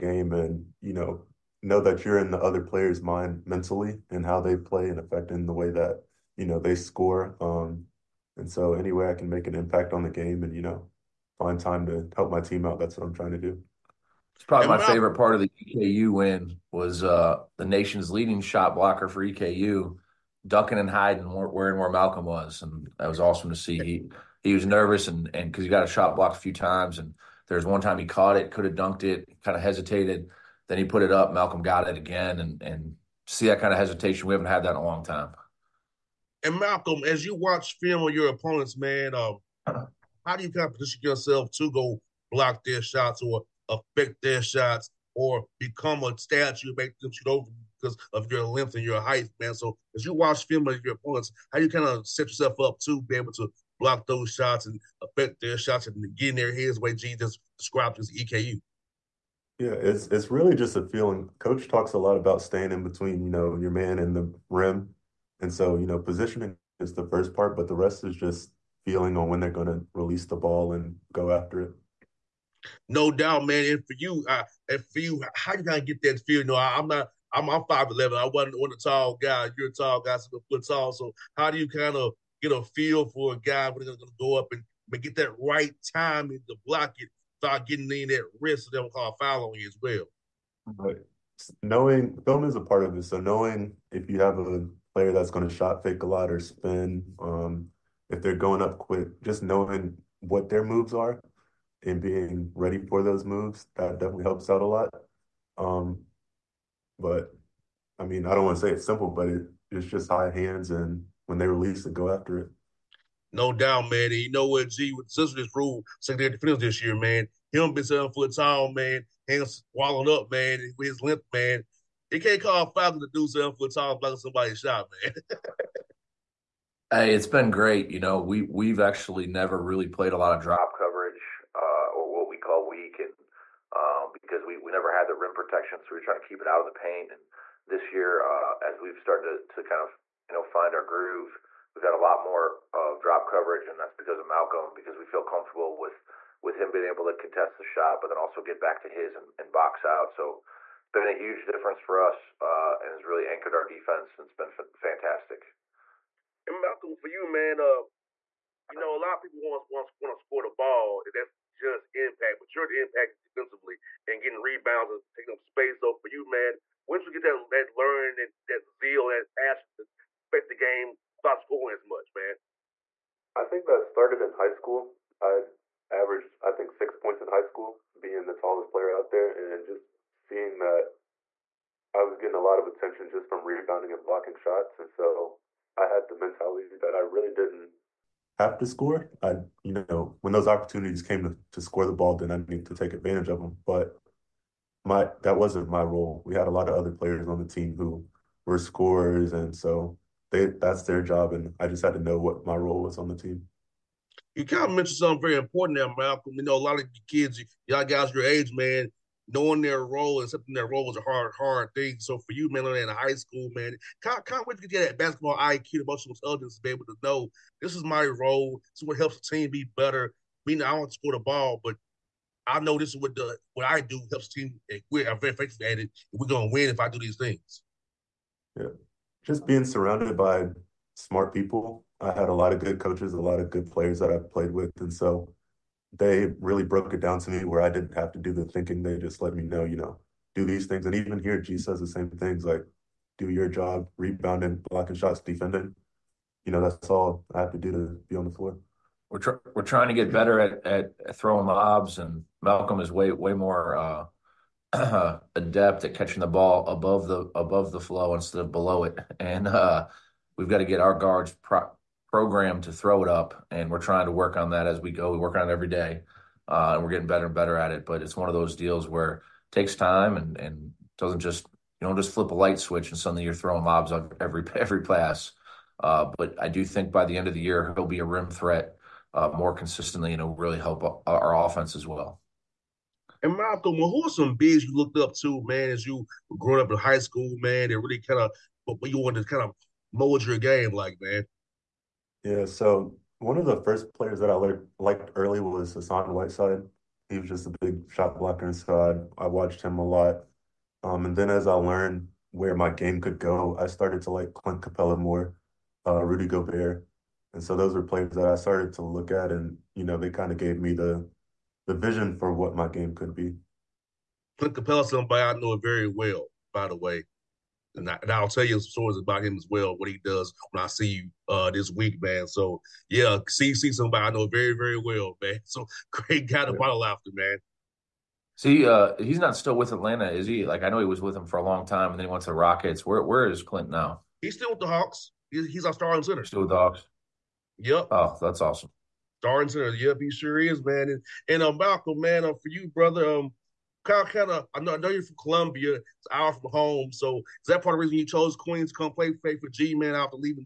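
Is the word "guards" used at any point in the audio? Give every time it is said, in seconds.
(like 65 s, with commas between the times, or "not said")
260 s.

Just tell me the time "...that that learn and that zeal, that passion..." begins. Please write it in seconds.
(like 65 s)
167 s.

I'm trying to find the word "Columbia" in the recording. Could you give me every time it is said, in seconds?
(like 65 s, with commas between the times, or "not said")
345 s.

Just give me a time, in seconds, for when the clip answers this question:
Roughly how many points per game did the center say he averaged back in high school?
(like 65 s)
176 s.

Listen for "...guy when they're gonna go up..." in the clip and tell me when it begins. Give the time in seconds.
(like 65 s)
83 s.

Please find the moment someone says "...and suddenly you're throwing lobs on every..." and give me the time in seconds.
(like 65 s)
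272 s.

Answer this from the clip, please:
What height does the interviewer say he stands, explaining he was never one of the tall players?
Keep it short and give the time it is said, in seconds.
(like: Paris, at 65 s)
5'11", at 77 s.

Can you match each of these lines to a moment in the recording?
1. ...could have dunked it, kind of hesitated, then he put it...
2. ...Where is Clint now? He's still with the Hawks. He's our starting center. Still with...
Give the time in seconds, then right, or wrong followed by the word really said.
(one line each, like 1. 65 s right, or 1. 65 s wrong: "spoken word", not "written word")
1. 28 s right
2. 333 s right.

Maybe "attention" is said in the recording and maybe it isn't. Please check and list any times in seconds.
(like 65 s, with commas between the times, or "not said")
182 s.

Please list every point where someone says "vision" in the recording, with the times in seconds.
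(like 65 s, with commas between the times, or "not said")
311 s.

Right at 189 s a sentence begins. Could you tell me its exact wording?
I, you know, when those opportunities came to, to score the ball, then I needed to take advantage of them.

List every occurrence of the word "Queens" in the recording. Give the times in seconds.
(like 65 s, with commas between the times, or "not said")
348 s.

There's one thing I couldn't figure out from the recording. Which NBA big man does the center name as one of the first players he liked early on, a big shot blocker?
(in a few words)
Hassan Whiteside.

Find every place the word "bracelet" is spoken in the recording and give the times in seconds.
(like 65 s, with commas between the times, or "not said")
not said.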